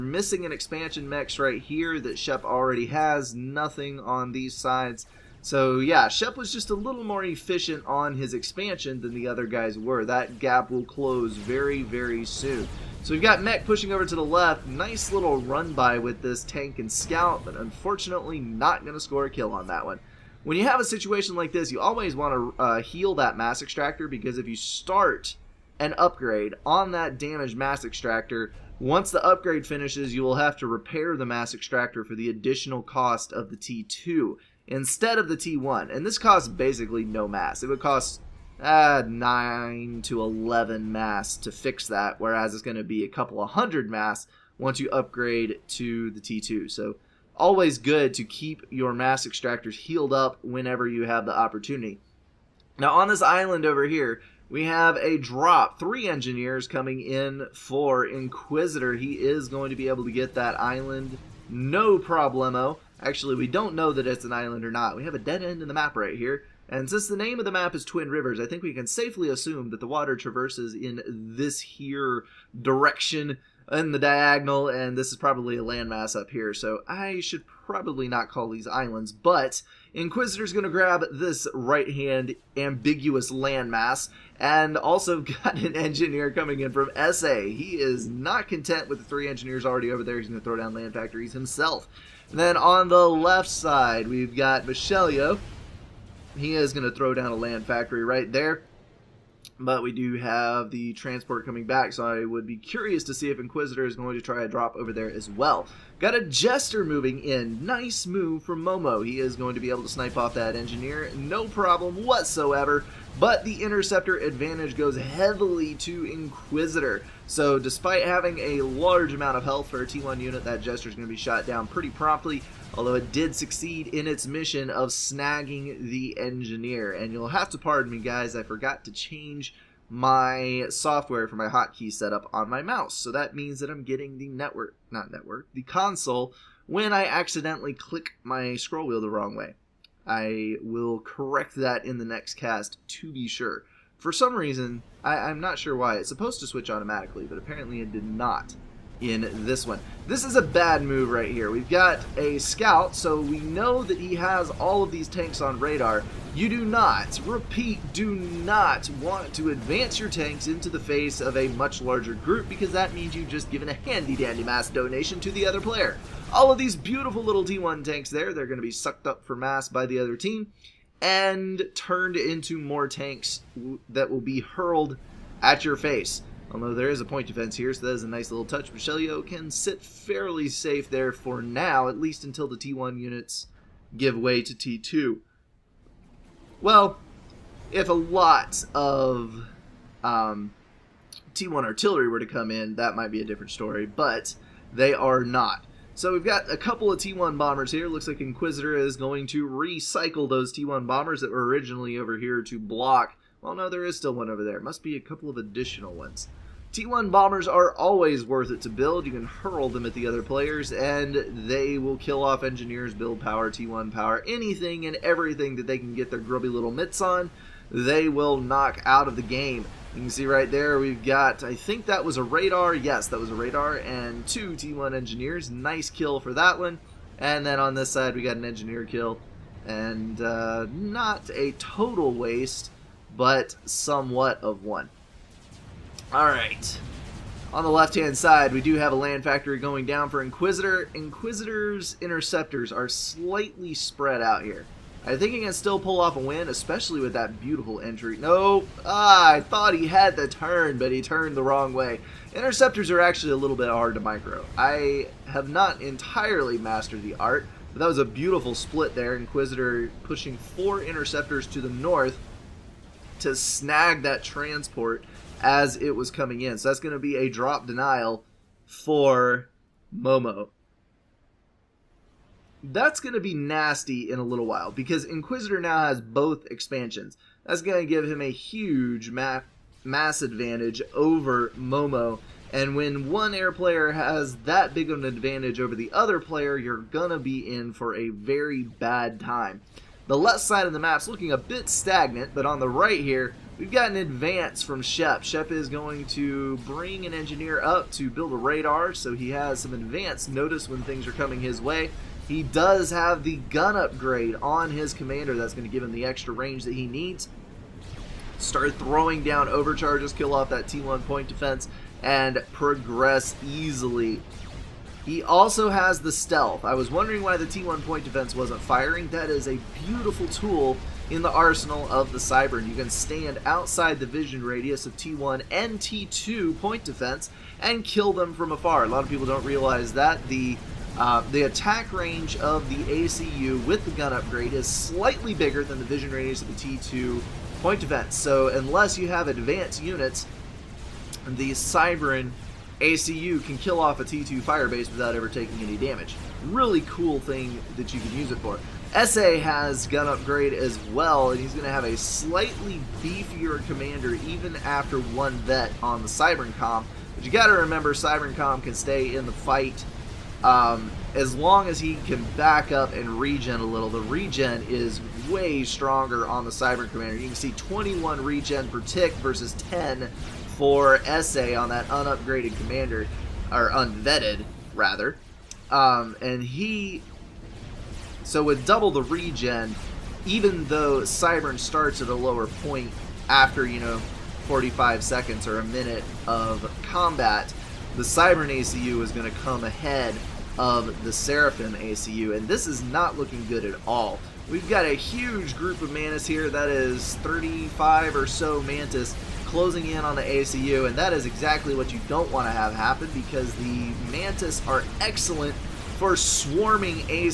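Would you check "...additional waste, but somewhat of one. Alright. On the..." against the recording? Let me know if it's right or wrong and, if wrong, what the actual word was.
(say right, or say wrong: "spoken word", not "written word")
wrong: "total", not "additional".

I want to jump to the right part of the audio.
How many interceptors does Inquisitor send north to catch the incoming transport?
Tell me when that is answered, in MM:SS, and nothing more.
04:20.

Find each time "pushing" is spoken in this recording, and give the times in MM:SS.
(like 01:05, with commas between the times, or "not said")
00:13, 04:20.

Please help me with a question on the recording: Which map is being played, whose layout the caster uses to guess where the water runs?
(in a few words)
Twin Rivers.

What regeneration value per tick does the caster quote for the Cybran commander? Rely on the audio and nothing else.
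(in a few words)
21.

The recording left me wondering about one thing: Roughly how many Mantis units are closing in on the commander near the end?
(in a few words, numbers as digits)
35.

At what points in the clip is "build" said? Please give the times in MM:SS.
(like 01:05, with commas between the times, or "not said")
03:28, 03:32, 04:58.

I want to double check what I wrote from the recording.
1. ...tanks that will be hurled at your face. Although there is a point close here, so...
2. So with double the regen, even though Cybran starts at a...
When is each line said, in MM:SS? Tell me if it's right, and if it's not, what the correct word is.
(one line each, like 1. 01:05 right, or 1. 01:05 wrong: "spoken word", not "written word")
1. 02:52 wrong: "defense", not "close"
2. 06:18 right.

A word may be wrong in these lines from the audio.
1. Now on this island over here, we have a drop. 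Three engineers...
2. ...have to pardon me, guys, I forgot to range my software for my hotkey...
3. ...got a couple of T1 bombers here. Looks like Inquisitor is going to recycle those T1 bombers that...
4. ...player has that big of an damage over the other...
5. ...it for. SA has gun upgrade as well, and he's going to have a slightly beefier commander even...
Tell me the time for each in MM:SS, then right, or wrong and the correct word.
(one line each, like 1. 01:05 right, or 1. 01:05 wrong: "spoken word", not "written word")
1. 00:52 right
2. 02:07 wrong: "change", not "range"
3. 03:16 right
4. 04:43 wrong: "advantage", not "damage"
5. 05:48 right.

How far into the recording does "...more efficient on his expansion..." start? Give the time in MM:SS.
00:07.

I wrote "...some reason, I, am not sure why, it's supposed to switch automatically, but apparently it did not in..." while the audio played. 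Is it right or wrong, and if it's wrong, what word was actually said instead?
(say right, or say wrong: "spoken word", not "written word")
right.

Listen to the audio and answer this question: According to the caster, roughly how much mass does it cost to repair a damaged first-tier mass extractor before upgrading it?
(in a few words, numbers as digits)
9 to 11.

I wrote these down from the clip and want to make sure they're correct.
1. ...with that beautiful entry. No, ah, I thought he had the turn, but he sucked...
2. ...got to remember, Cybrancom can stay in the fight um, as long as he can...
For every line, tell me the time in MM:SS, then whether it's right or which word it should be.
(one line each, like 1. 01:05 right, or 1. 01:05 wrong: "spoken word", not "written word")
1. 04:07 wrong: "turned", not "sucked"
2. 05:57 right.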